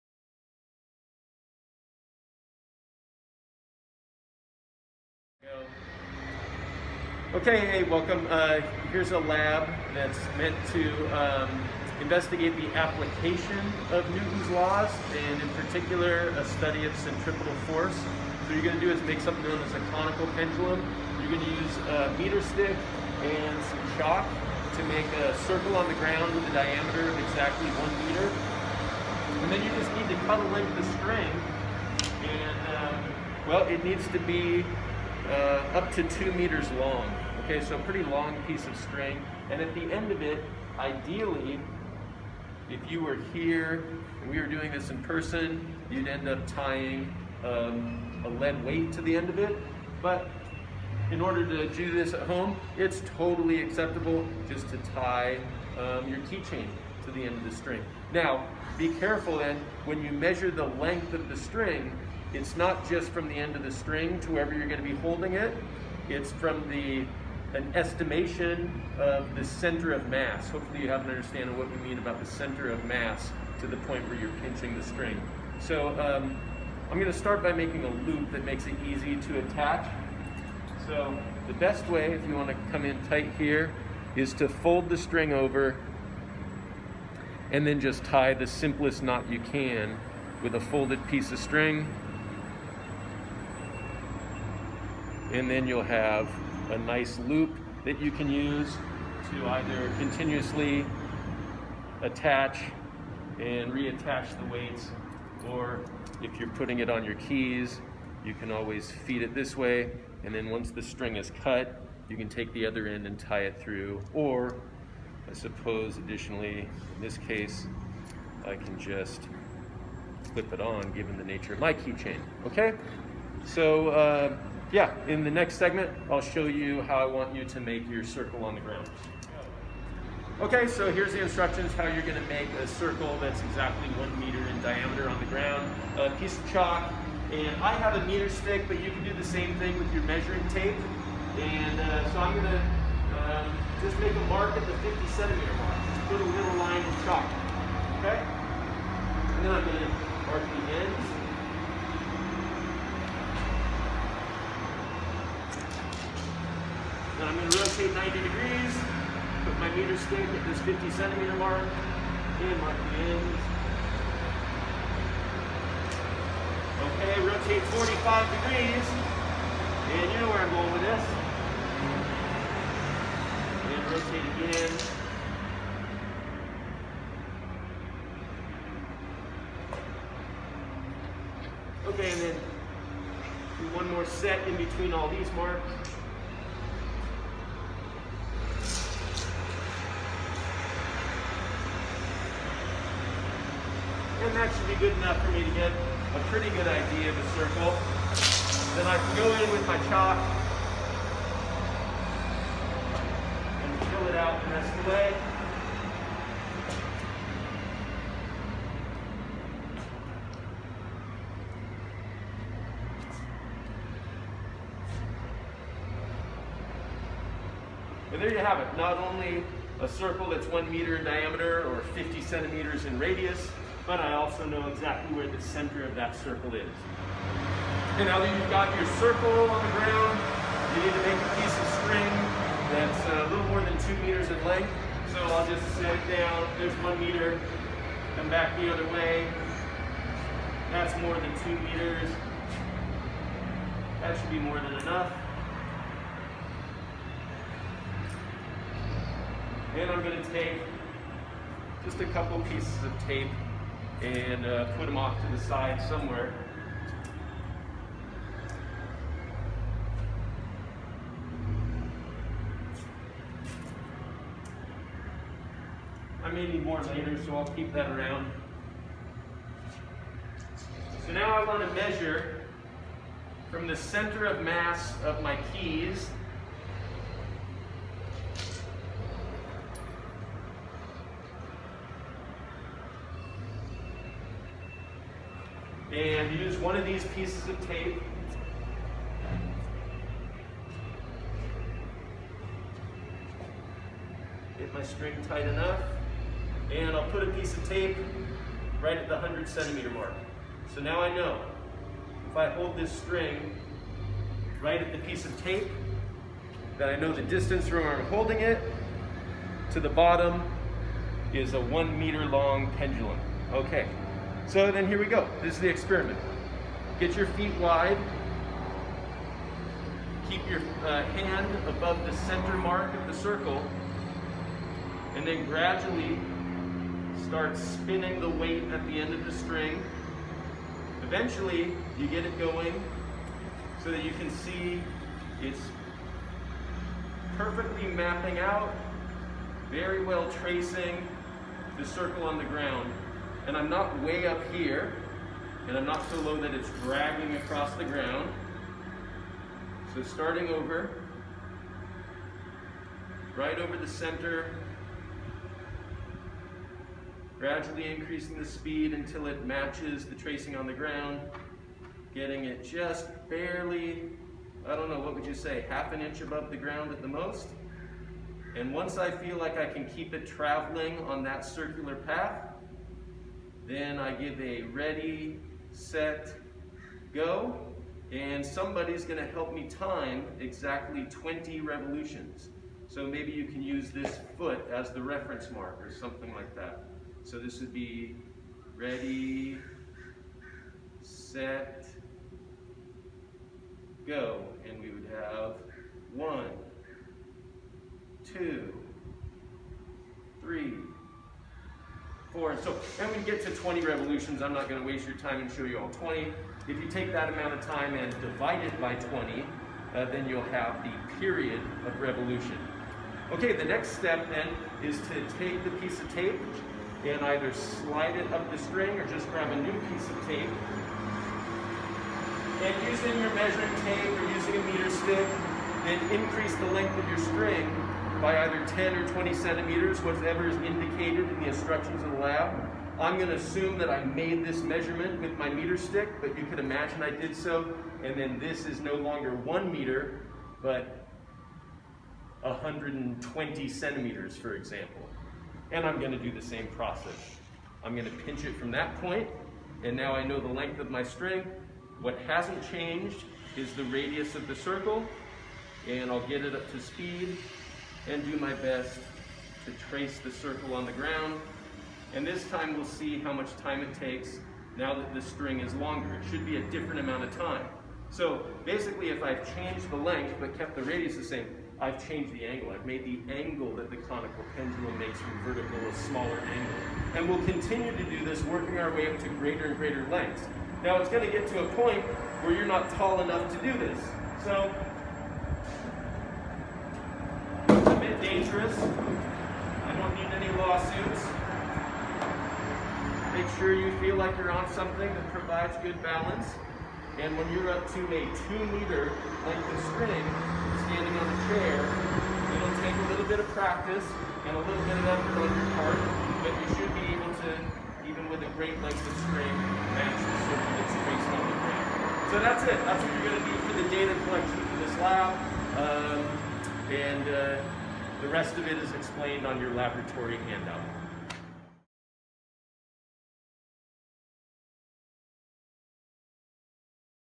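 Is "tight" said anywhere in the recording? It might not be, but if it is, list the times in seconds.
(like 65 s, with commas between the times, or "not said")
83 s, 295 s.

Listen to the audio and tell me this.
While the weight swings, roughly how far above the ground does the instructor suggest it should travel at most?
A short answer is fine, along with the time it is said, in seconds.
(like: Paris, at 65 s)
half an inch, at 365 s.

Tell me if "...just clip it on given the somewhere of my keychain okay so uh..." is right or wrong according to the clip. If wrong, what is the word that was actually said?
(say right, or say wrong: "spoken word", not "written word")
wrong: "nature", not "somewhere".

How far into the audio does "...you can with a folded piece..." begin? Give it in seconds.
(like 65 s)
89 s.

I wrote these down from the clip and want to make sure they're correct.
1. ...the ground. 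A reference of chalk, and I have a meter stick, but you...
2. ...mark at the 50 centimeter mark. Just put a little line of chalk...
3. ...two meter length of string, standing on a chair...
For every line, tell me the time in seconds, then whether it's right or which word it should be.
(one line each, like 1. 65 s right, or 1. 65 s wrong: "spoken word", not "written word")
1. 135 s wrong: "piece", not "reference"
2. 144 s right
3. 498 s right.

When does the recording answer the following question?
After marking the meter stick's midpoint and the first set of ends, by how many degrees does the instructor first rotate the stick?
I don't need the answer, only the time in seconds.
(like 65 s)
157 s.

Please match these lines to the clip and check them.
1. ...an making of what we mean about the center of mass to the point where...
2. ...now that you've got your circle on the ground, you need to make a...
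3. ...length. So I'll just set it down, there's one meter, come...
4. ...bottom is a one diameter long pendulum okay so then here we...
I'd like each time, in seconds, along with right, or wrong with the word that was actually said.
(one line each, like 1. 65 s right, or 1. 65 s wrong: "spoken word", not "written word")
1. 71 s wrong: "understanding", not "making"
2. 228 s right
3. 234 s right
4. 309 s wrong: "meter", not "diameter".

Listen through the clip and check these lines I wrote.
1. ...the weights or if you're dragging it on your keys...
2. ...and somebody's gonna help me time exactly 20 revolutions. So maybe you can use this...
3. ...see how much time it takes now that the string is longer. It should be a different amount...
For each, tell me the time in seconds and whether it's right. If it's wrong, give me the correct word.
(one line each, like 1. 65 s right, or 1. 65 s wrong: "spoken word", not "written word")
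1. 104 s wrong: "putting", not "dragging"
2. 378 s right
3. 462 s right.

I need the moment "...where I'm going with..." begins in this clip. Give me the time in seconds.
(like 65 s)
170 s.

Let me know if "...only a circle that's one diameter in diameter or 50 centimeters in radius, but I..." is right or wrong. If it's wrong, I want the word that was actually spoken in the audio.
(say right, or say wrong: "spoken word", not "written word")
wrong: "meter", not "diameter".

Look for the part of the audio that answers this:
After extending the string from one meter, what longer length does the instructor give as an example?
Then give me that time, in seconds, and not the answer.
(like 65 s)
442 s.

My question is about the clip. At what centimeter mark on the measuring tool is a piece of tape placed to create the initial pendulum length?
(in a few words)
100 centimeters.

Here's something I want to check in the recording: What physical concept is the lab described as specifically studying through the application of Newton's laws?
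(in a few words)
centripetal force.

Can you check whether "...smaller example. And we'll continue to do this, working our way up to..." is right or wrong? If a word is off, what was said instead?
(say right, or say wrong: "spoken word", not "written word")
wrong: "angle", not "example".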